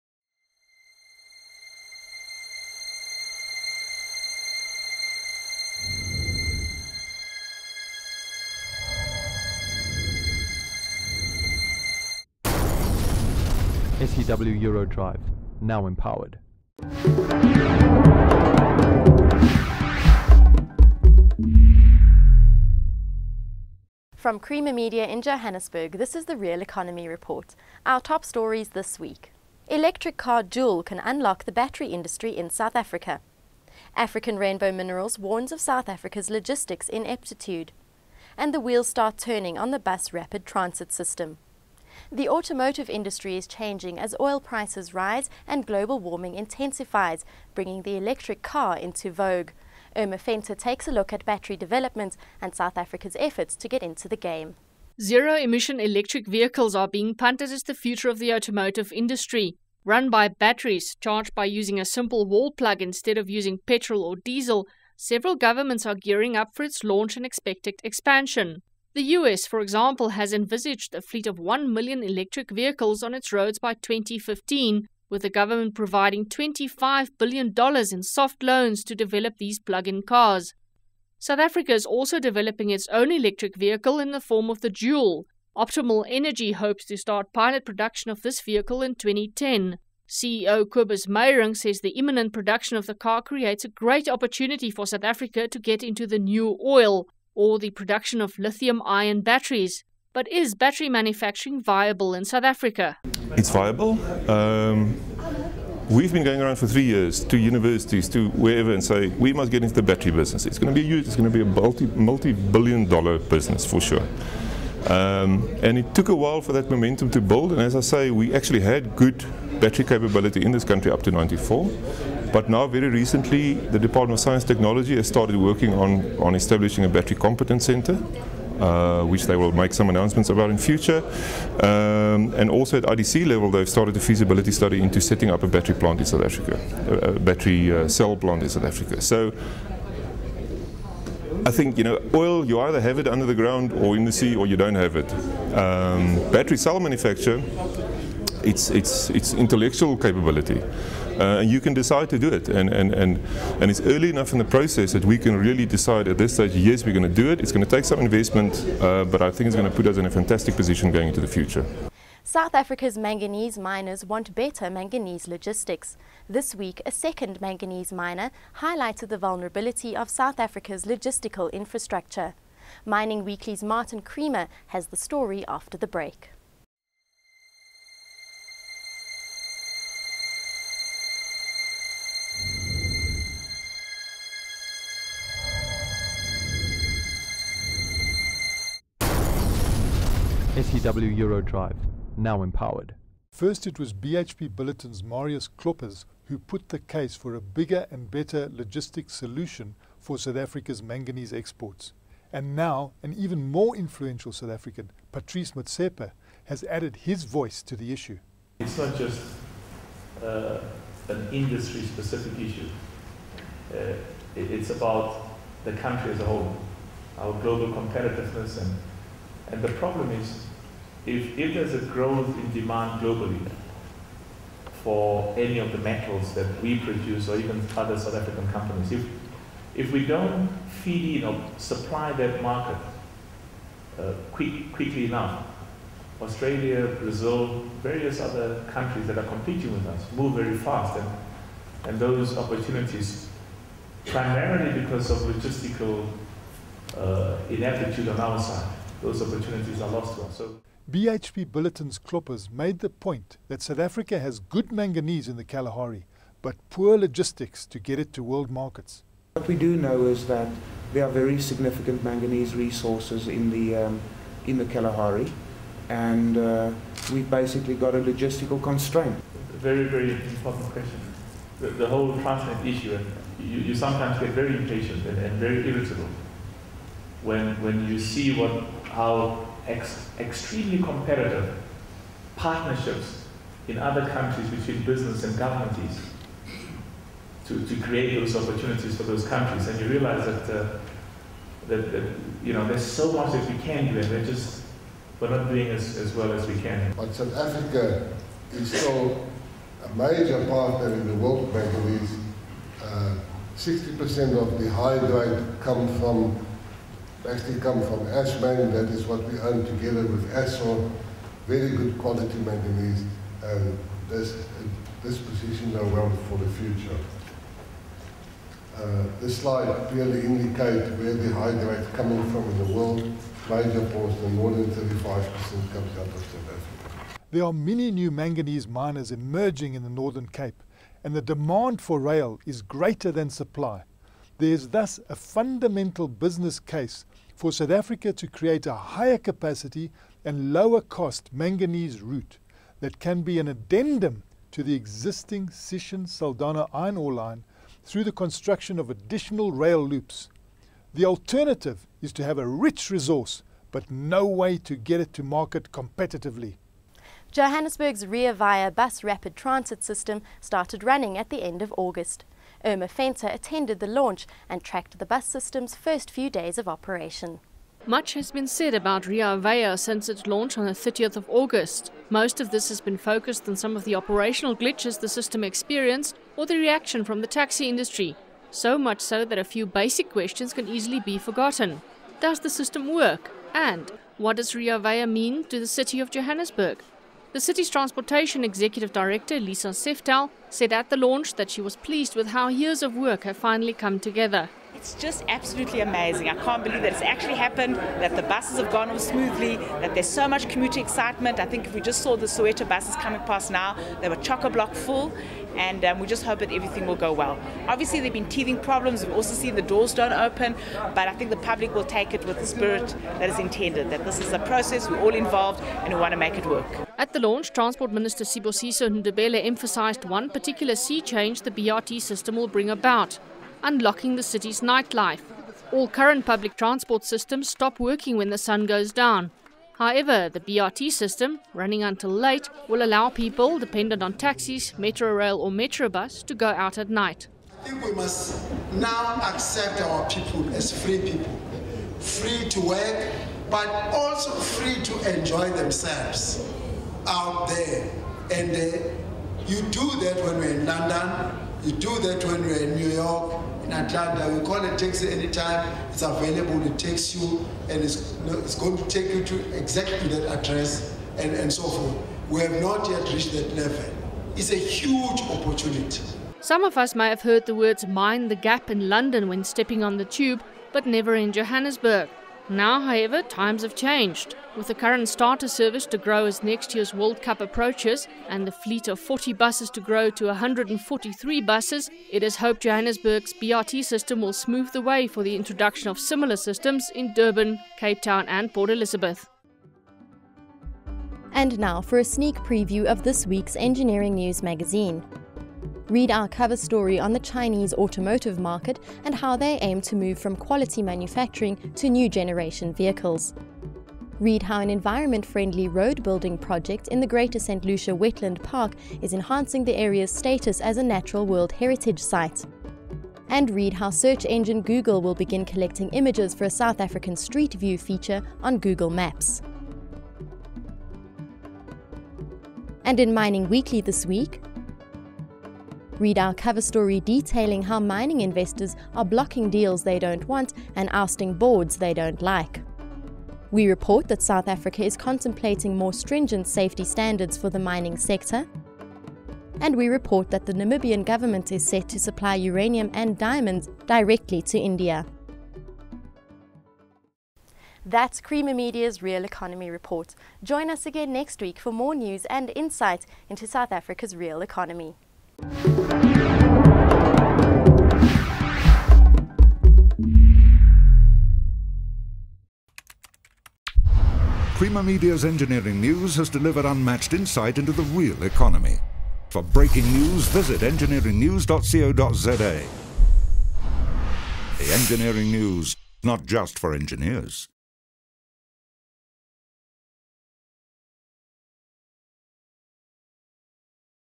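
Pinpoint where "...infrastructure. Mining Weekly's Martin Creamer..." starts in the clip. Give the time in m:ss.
2:51.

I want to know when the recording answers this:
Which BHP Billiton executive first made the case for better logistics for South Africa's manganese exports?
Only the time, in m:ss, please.
3:15.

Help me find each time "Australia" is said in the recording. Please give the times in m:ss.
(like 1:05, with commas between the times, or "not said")
3:56.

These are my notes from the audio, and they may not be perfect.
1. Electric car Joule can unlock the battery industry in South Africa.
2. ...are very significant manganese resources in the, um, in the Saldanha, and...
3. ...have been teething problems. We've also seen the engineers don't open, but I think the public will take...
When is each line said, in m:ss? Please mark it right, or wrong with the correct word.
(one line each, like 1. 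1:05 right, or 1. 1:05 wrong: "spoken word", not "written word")
1. 0:29 right
2. 4:21 wrong: "Kalahari", not "Saldanha"
3. 6:48 wrong: "doors", not "engineers".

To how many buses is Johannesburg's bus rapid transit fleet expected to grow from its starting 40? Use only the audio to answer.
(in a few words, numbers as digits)
143.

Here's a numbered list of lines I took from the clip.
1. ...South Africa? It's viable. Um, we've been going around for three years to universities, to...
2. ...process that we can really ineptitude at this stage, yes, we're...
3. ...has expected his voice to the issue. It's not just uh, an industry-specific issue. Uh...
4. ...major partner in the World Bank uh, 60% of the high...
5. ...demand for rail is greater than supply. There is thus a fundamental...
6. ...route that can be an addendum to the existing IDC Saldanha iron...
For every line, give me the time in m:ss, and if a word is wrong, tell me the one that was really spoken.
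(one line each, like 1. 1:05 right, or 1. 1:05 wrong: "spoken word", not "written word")
1. 1:42 right
2. 2:34 wrong: "decide", not "ineptitude"
3. 3:26 wrong: "added", not "expected"
4. 4:59 right
5. 5:31 right
6. 5:42 wrong: "Sishen", not "IDC".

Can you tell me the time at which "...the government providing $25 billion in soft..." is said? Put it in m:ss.
1:15.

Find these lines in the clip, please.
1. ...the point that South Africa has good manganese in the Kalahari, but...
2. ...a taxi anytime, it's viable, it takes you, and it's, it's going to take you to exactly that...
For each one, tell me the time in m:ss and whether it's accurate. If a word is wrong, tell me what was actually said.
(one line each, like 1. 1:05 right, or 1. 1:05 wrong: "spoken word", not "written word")
1. 4:12 right
2. 7:34 wrong: "available", not "viable".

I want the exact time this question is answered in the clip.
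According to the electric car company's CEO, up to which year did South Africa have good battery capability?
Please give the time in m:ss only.
2:01.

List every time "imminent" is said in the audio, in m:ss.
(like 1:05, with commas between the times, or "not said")
1:31.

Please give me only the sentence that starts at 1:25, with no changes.
Optimal Energy hopes to start pilot production of this vehicle in 2010.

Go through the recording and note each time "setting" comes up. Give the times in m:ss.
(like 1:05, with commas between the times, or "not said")
2:15.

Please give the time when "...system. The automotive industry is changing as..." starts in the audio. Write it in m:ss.
0:40.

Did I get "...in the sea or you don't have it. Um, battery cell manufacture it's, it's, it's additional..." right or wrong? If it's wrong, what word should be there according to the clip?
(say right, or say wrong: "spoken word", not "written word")
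wrong: "intellectual", not "additional".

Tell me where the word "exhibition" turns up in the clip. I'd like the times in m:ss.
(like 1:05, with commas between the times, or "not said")
not said.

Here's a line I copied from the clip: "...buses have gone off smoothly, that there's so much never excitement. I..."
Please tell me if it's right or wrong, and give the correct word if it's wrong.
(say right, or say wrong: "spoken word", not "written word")
wrong: "commuter", not "never".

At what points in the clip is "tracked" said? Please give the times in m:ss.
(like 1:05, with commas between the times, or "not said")
6:04.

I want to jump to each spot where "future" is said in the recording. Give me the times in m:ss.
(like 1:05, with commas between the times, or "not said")
0:57, 2:10, 2:41, 5:16.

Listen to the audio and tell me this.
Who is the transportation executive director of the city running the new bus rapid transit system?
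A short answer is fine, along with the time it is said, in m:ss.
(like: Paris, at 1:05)
Lisa Seftel, at 6:29.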